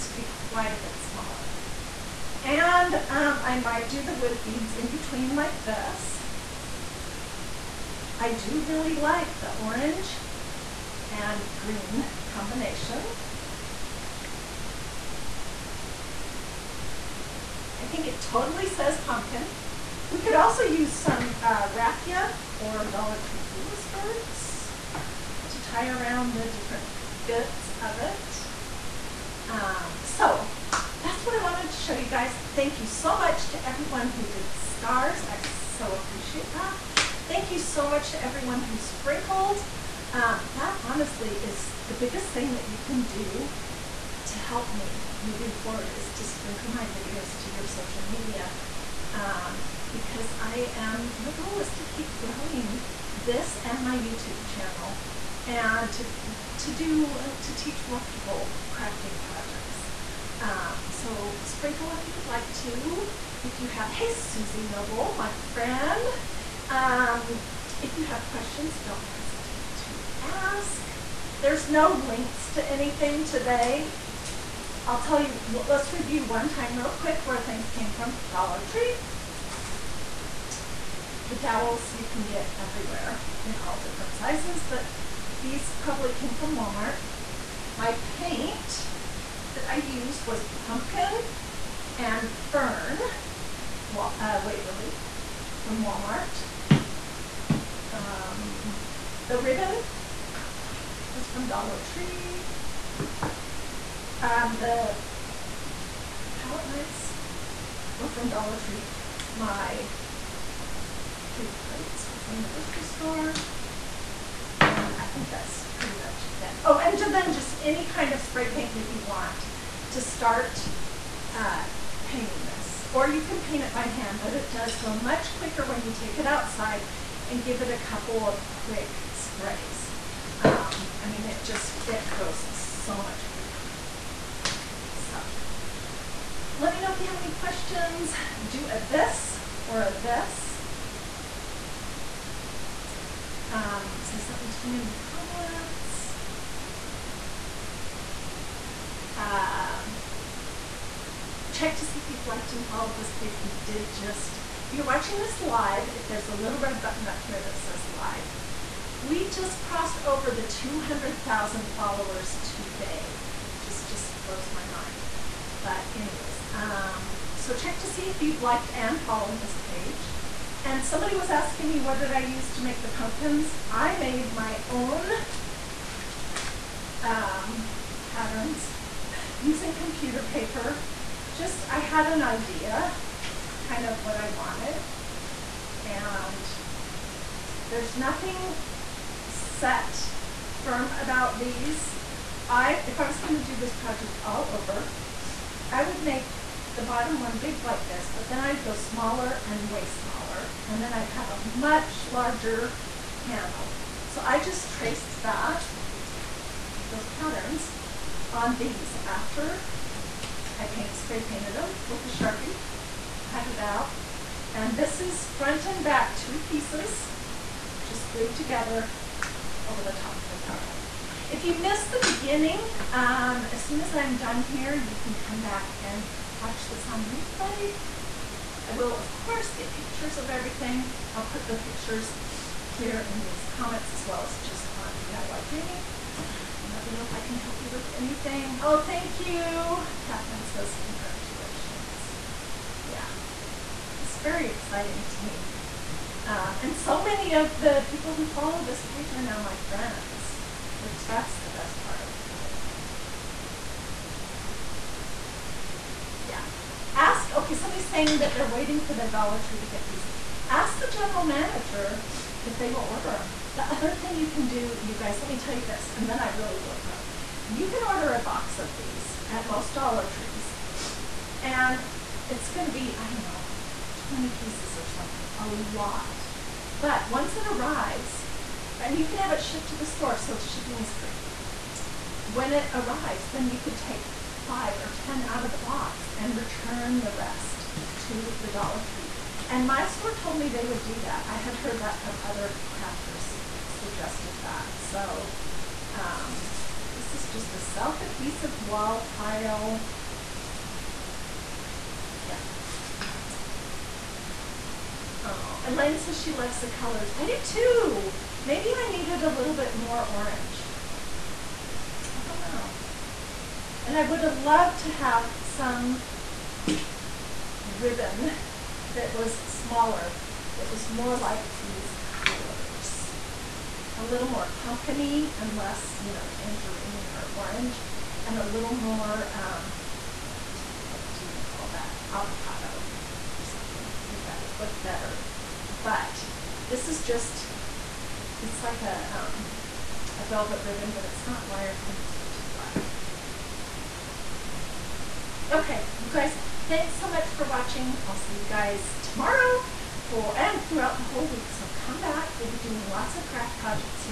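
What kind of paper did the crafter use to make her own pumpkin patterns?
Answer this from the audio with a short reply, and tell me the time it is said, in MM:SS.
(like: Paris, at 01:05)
computer paper, at 02:59.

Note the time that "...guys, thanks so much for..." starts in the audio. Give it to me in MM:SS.
05:46.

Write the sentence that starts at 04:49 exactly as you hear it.
And my store told me they would do that.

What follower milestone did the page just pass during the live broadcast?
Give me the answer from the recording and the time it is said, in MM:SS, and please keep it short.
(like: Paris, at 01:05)
200,000, at 02:40.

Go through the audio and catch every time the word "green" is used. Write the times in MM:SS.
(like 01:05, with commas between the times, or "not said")
00:11.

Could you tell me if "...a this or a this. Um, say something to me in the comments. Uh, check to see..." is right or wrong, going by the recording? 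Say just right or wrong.
right.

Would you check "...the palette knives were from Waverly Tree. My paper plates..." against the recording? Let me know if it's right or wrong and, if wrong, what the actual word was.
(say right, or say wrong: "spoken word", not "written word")
wrong: "Dollar", not "Waverly".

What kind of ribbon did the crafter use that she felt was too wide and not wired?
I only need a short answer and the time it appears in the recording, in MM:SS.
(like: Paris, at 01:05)
velvet ribbon, at 05:40.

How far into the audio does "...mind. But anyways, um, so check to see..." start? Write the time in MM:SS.
02:44.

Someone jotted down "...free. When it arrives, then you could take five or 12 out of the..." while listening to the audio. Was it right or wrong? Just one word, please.
wrong.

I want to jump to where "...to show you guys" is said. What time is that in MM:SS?
00:31.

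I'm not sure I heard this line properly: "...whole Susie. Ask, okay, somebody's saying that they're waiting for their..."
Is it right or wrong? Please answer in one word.
wrong.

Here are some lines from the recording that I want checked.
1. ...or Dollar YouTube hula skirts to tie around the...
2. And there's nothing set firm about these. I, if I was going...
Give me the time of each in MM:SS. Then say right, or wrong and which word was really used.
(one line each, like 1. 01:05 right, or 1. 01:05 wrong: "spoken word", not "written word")
1. 00:22 wrong: "Tree", not "YouTube"
2. 03:05 right.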